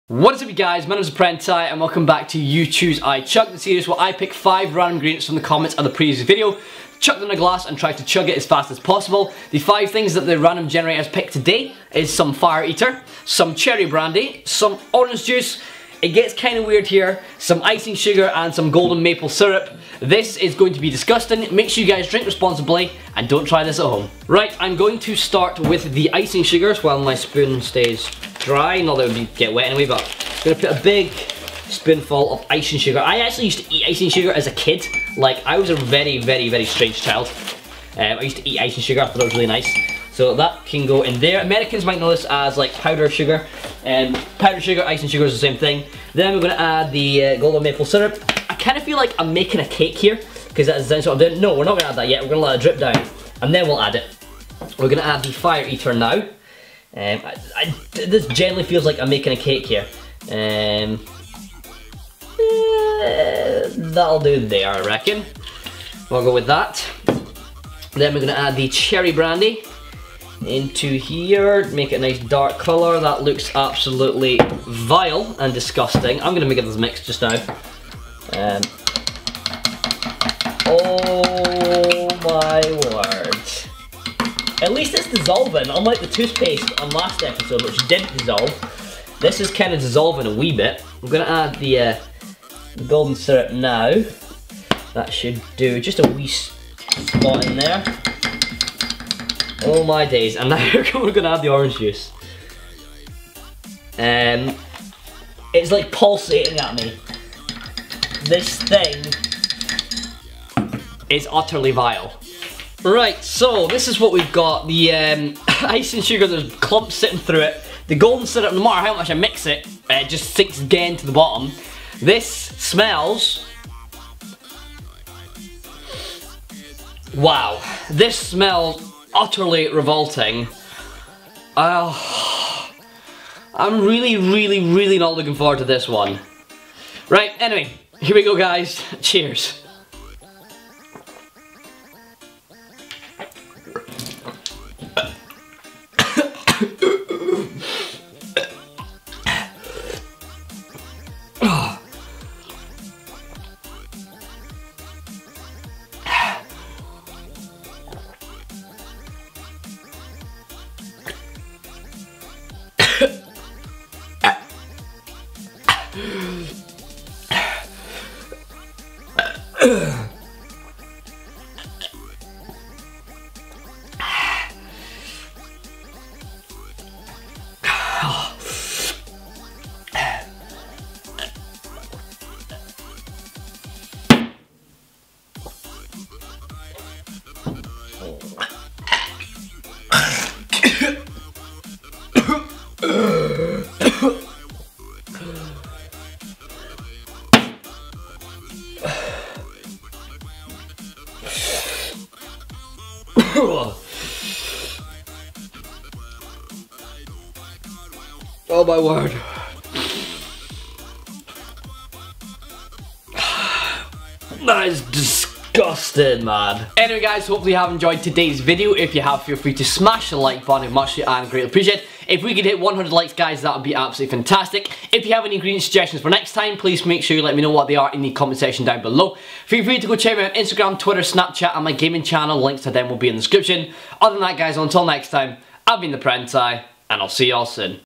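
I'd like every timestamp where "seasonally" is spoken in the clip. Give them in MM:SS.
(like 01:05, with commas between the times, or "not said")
not said.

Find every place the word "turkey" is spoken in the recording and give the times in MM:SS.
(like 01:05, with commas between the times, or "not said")
not said.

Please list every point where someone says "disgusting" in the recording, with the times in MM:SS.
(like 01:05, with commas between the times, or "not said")
00:20, 01:15, 03:34.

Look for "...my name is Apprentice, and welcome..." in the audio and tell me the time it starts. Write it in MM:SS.
00:00.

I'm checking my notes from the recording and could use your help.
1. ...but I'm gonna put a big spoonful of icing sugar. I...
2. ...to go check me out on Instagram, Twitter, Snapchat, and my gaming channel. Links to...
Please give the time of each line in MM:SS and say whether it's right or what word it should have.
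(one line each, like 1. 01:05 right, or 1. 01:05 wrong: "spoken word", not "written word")
1. 00:29 right
2. 03:49 right.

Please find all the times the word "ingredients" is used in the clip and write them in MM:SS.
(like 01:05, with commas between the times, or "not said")
00:04, 03:45.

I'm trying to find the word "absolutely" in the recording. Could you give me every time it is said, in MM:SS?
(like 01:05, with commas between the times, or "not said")
01:13, 03:43.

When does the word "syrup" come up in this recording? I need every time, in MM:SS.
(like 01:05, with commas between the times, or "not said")
00:19, 00:47, 01:33, 01:58.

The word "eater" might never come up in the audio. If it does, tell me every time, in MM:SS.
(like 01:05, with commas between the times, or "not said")
00:12, 00:55.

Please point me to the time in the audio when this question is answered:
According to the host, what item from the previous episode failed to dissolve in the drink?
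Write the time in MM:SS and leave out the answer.
01:26.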